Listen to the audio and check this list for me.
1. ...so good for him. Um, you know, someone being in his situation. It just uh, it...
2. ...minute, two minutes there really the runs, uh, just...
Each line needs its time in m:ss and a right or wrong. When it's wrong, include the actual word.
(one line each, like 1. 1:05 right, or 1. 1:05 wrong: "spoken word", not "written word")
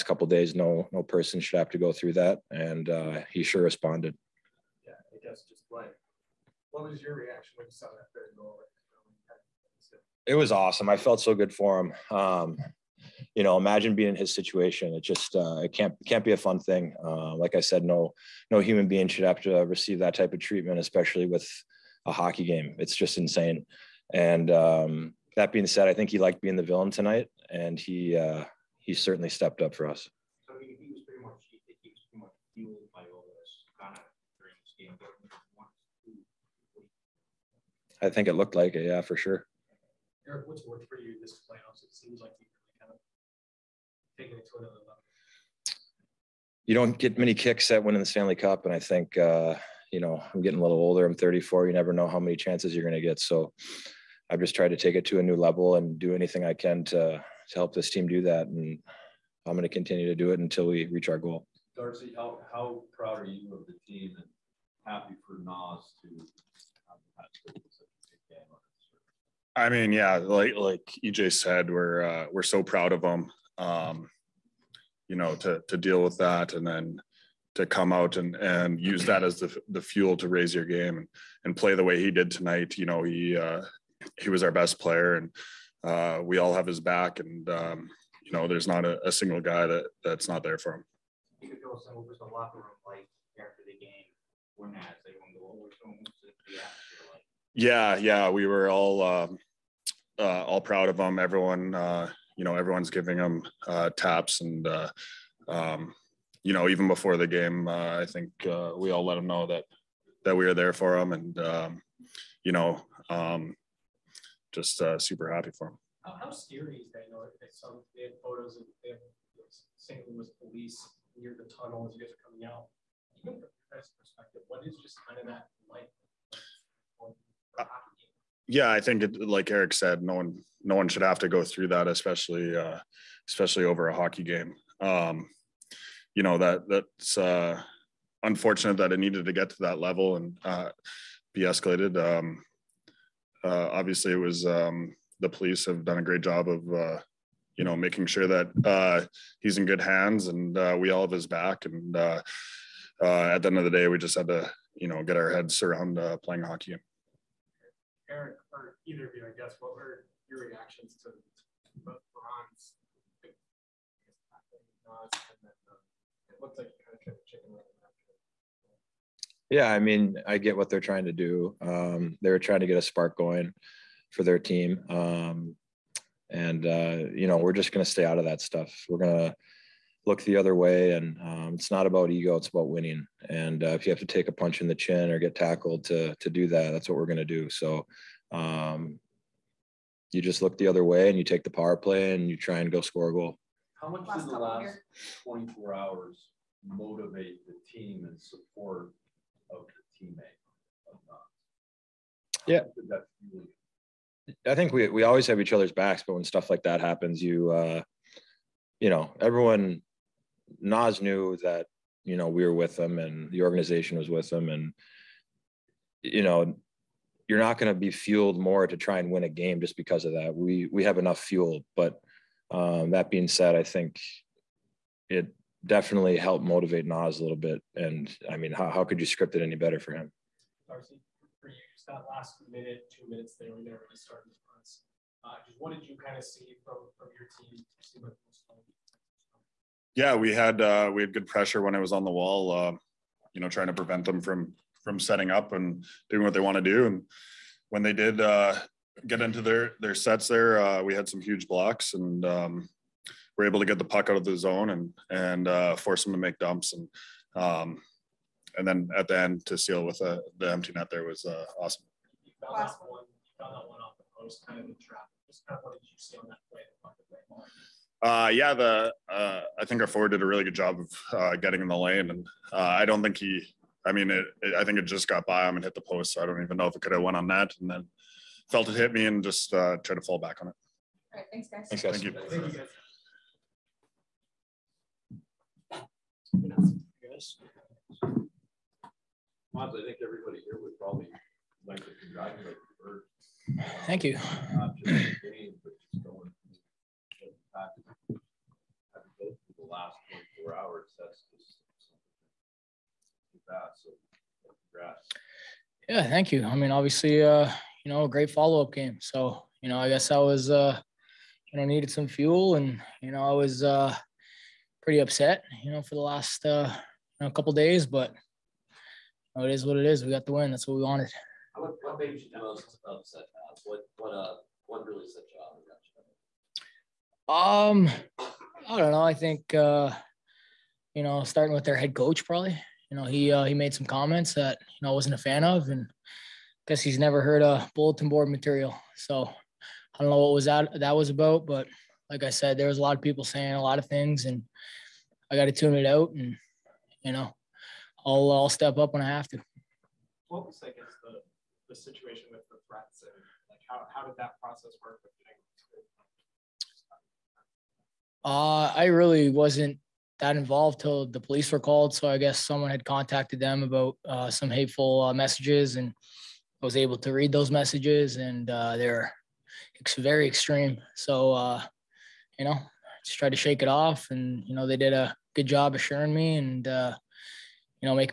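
1. 0:11 wrong: "imagine", not "someone"
2. 3:52 right.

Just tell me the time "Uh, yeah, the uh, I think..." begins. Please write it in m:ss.
4:28.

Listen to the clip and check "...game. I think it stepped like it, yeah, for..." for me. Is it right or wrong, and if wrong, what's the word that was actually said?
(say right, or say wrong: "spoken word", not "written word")
wrong: "looked", not "stepped".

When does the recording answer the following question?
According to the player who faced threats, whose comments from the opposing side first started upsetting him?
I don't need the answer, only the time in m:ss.
5:31.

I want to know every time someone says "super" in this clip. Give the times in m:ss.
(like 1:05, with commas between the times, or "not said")
1:54.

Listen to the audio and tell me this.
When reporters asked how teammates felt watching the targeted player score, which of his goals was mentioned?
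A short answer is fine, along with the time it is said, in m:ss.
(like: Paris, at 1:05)
third goal, at 0:08.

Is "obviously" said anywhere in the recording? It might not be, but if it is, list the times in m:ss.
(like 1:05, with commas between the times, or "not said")
2:23, 5:06.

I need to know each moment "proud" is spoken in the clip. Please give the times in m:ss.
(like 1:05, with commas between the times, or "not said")
1:02, 1:12, 1:40.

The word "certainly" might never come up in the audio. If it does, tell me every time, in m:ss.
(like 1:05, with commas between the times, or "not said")
0:28.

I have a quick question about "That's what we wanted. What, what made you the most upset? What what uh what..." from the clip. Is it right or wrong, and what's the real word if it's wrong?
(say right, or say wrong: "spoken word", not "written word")
right.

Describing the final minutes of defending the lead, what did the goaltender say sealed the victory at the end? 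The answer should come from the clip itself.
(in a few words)
the empty net.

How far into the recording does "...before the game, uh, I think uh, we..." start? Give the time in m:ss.
1:46.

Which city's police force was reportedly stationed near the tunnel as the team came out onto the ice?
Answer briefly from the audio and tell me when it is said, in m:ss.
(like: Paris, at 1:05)
St. Louis, at 1:59.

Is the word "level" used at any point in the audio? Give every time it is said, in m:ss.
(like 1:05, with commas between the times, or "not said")
0:44, 0:55, 2:19.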